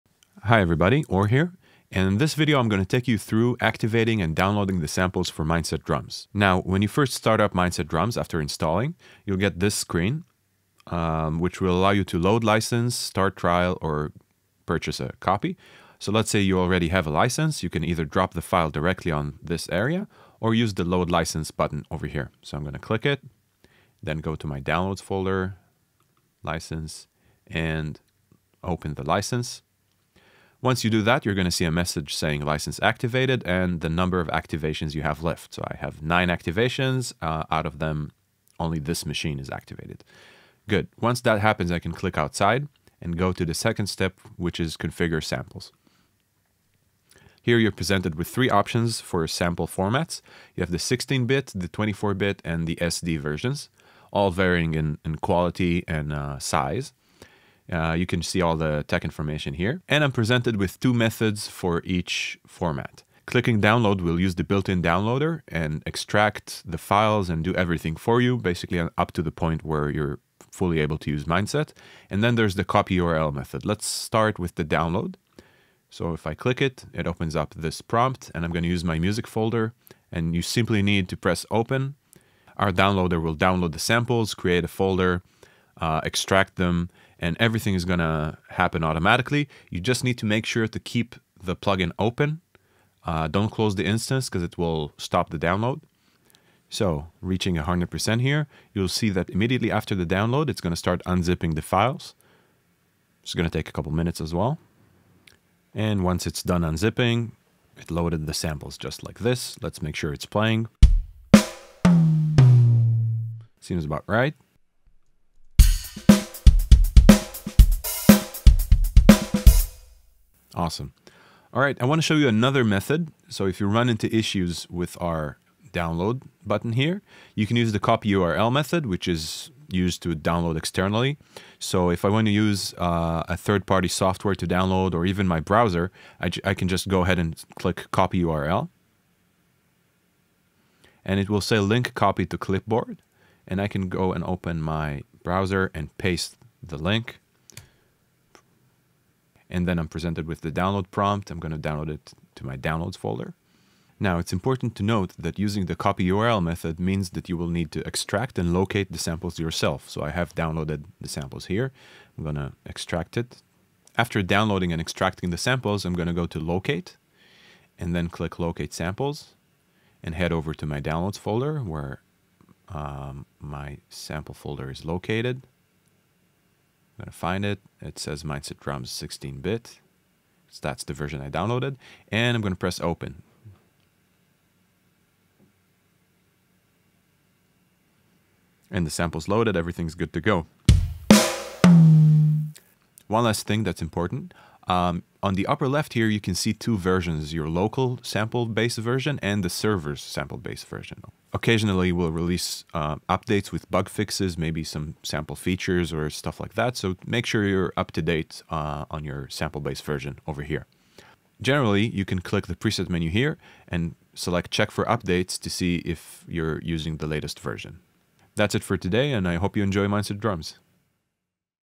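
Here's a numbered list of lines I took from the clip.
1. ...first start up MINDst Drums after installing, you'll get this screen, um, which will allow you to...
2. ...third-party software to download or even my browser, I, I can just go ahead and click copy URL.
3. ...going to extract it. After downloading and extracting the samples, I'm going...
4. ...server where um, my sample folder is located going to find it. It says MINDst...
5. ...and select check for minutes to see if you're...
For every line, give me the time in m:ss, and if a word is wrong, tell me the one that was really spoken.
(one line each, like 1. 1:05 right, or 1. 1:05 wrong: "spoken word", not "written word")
1. 0:06 right
2. 2:13 right
3. 2:42 right
4. 2:51 wrong: "folder", not "server"
5. 3:33 wrong: "updates", not "minutes".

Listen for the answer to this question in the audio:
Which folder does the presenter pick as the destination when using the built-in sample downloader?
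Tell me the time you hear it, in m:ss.
1:18.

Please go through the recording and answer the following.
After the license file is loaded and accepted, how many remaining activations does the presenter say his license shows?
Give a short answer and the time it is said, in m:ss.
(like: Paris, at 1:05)
9, at 0:36.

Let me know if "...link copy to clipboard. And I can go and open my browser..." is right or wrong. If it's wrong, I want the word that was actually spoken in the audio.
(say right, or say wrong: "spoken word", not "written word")
right.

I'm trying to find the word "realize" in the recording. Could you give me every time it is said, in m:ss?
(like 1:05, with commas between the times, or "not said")
not said.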